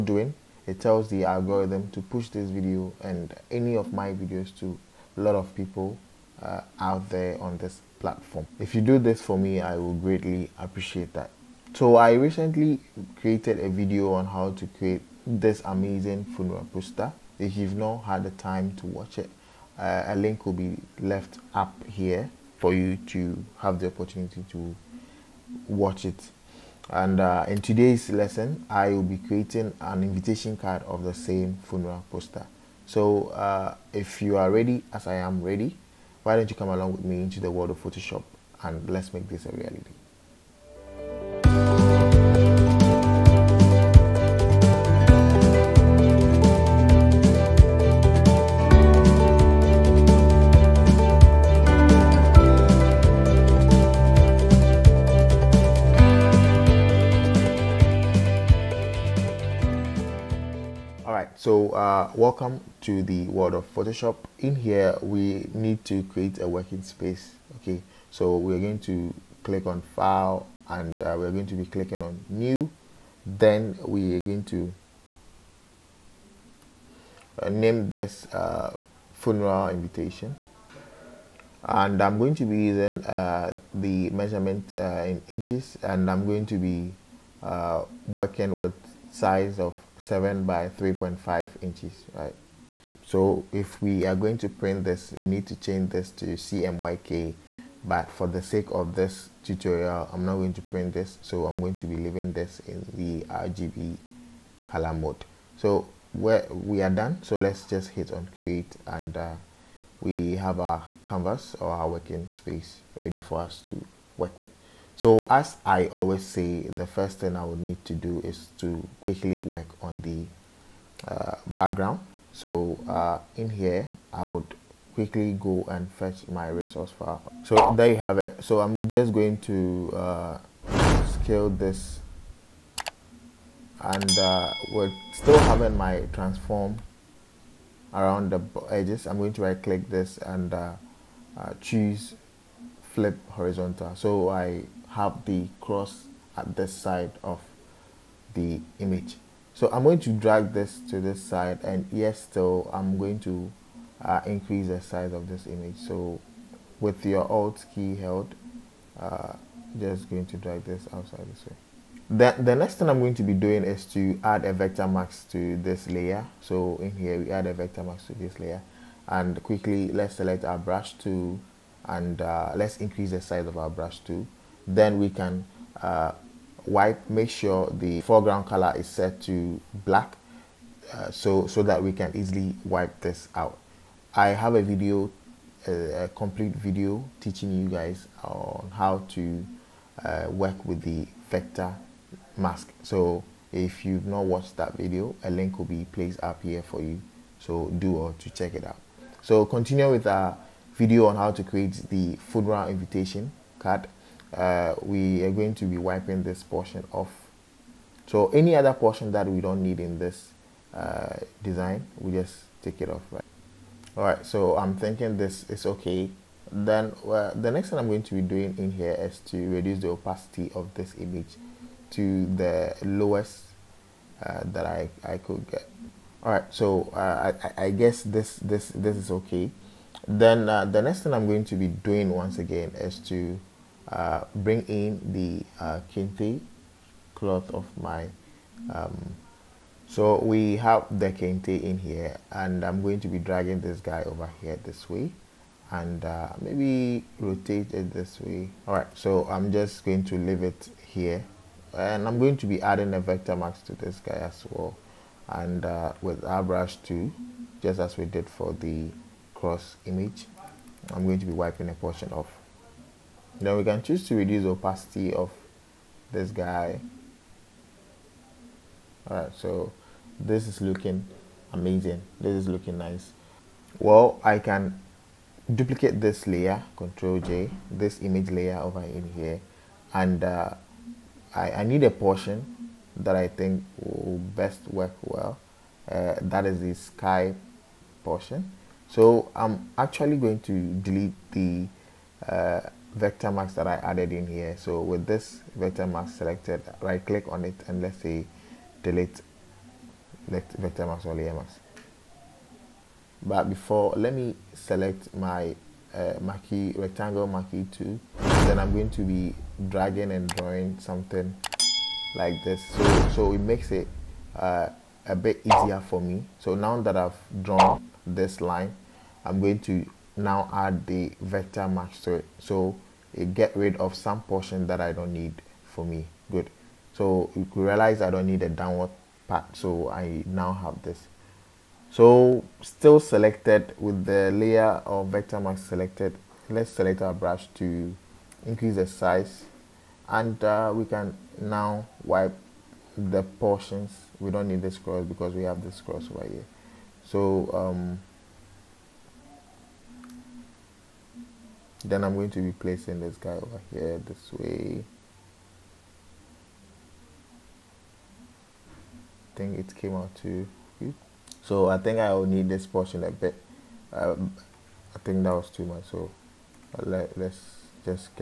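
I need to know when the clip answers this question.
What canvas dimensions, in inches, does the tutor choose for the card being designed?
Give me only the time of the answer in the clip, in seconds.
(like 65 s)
90 s.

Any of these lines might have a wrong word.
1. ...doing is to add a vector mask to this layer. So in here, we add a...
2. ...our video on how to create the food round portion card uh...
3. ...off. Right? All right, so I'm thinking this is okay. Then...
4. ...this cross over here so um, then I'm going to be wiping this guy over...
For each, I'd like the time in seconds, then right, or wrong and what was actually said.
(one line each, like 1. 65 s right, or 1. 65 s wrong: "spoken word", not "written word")
1. 163 s right
2. 200 s wrong: "invitation", not "portion"
3. 212 s right
4. 345 s wrong: "placing", not "wiping".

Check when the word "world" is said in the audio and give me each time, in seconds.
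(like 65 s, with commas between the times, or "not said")
37 s, 63 s.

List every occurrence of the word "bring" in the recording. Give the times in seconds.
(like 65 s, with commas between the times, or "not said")
234 s.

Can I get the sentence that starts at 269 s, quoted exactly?
Alright, so this is looking amazing.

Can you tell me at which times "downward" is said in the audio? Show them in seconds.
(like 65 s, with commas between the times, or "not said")
328 s.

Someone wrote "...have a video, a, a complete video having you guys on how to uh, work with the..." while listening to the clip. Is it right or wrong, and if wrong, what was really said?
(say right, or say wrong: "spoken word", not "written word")
wrong: "teaching", not "having".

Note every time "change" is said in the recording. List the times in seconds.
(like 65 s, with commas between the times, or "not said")
95 s.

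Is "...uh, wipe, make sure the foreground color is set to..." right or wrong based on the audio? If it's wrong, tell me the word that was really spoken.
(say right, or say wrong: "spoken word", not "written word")
right.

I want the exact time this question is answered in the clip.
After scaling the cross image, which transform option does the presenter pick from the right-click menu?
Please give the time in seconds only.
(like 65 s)
142 s.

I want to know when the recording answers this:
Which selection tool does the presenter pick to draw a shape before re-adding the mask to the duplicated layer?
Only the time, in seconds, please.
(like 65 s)
306 s.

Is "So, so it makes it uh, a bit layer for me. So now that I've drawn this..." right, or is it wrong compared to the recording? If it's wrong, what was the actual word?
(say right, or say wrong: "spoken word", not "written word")
wrong: "easier", not "layer".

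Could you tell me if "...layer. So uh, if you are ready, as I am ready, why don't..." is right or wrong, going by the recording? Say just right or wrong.
wrong.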